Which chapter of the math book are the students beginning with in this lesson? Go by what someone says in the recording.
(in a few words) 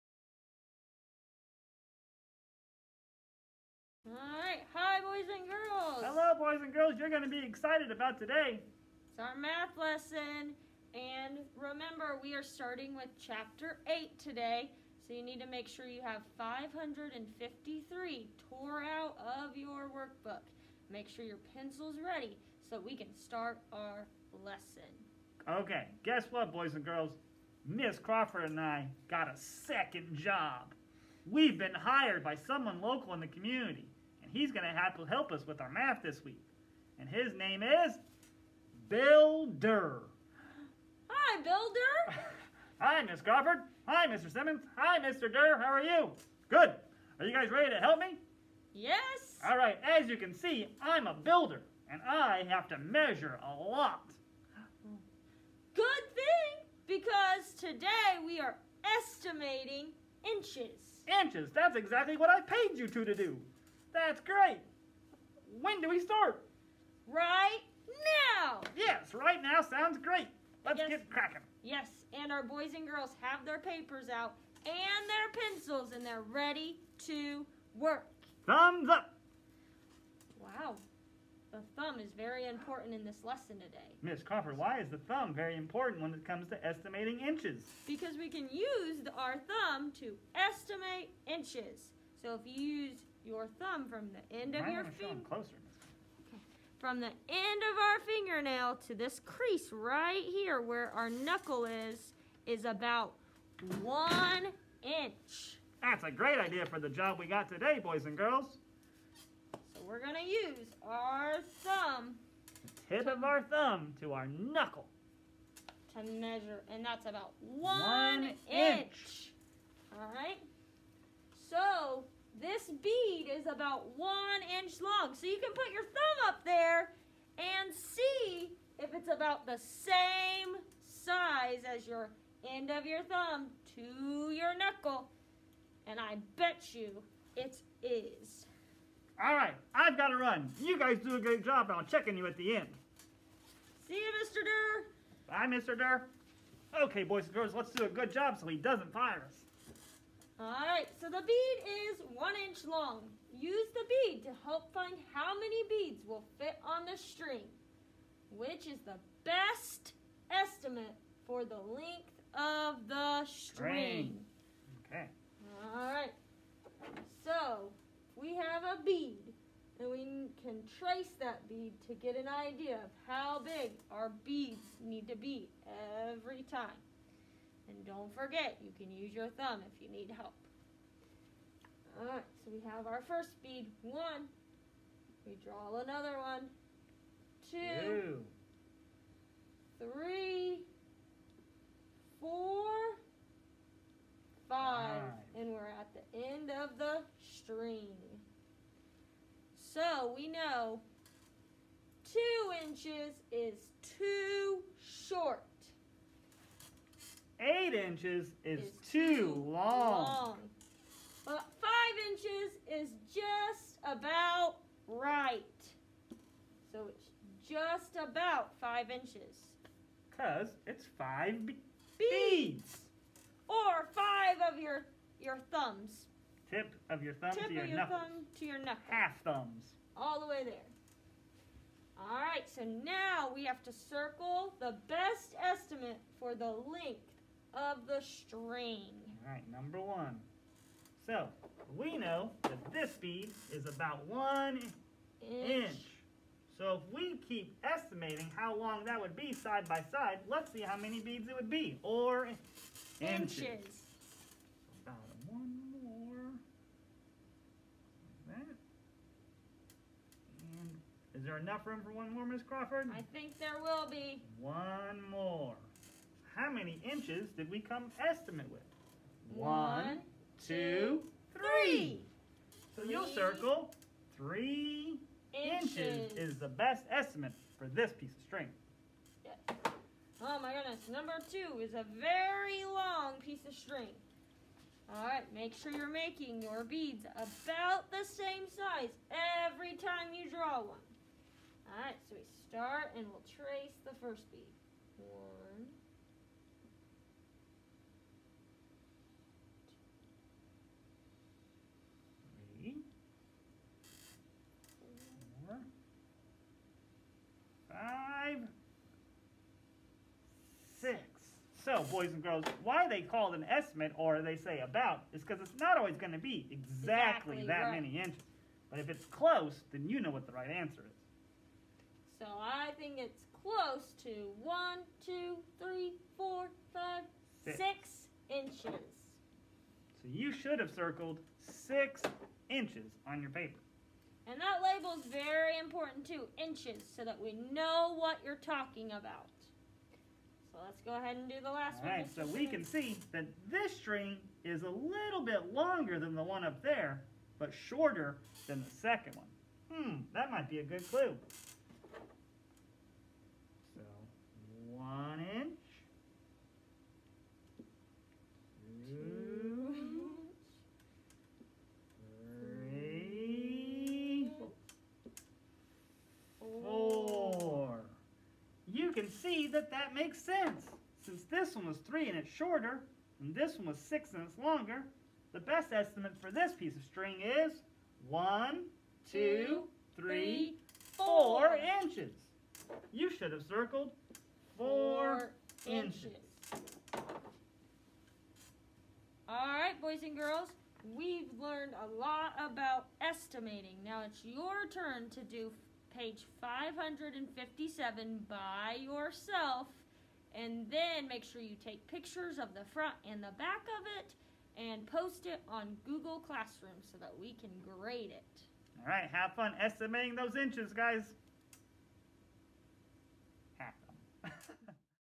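8.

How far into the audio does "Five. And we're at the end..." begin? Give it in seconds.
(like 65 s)
194 s.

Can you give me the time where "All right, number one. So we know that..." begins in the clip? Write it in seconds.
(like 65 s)
239 s.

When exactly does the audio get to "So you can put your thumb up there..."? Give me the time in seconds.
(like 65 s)
125 s.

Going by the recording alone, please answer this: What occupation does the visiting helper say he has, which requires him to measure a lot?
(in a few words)
builder.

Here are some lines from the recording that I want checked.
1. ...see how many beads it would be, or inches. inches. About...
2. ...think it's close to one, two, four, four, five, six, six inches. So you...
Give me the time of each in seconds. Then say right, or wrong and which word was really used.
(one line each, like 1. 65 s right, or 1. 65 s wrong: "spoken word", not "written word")
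1. 250 s right
2. 322 s wrong: "three", not "four".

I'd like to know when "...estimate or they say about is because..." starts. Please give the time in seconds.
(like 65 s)
313 s.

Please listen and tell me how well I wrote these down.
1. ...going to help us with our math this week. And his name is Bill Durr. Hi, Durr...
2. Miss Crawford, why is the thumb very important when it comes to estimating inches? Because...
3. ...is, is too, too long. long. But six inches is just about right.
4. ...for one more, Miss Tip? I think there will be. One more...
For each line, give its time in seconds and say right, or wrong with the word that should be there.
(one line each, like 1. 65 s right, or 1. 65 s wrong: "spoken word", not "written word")
1. 34 s wrong: "Bill", not "Durr"
2. 84 s right
3. 208 s wrong: "five", not "six"
4. 261 s wrong: "Crawford", not "Tip".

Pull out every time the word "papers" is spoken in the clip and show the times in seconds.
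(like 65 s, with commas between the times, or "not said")
73 s, 333 s.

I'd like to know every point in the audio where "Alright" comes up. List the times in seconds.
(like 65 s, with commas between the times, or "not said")
181 s.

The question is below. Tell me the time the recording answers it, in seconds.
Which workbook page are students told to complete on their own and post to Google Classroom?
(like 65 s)
395 s.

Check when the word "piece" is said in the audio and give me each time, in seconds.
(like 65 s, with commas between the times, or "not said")
277 s, 283 s, 376 s.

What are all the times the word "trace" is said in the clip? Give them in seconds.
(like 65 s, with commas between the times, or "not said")
170 s, 293 s.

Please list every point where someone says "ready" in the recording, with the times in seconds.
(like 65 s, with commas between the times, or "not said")
22 s, 47 s, 76 s.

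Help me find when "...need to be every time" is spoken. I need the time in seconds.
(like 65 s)
174 s.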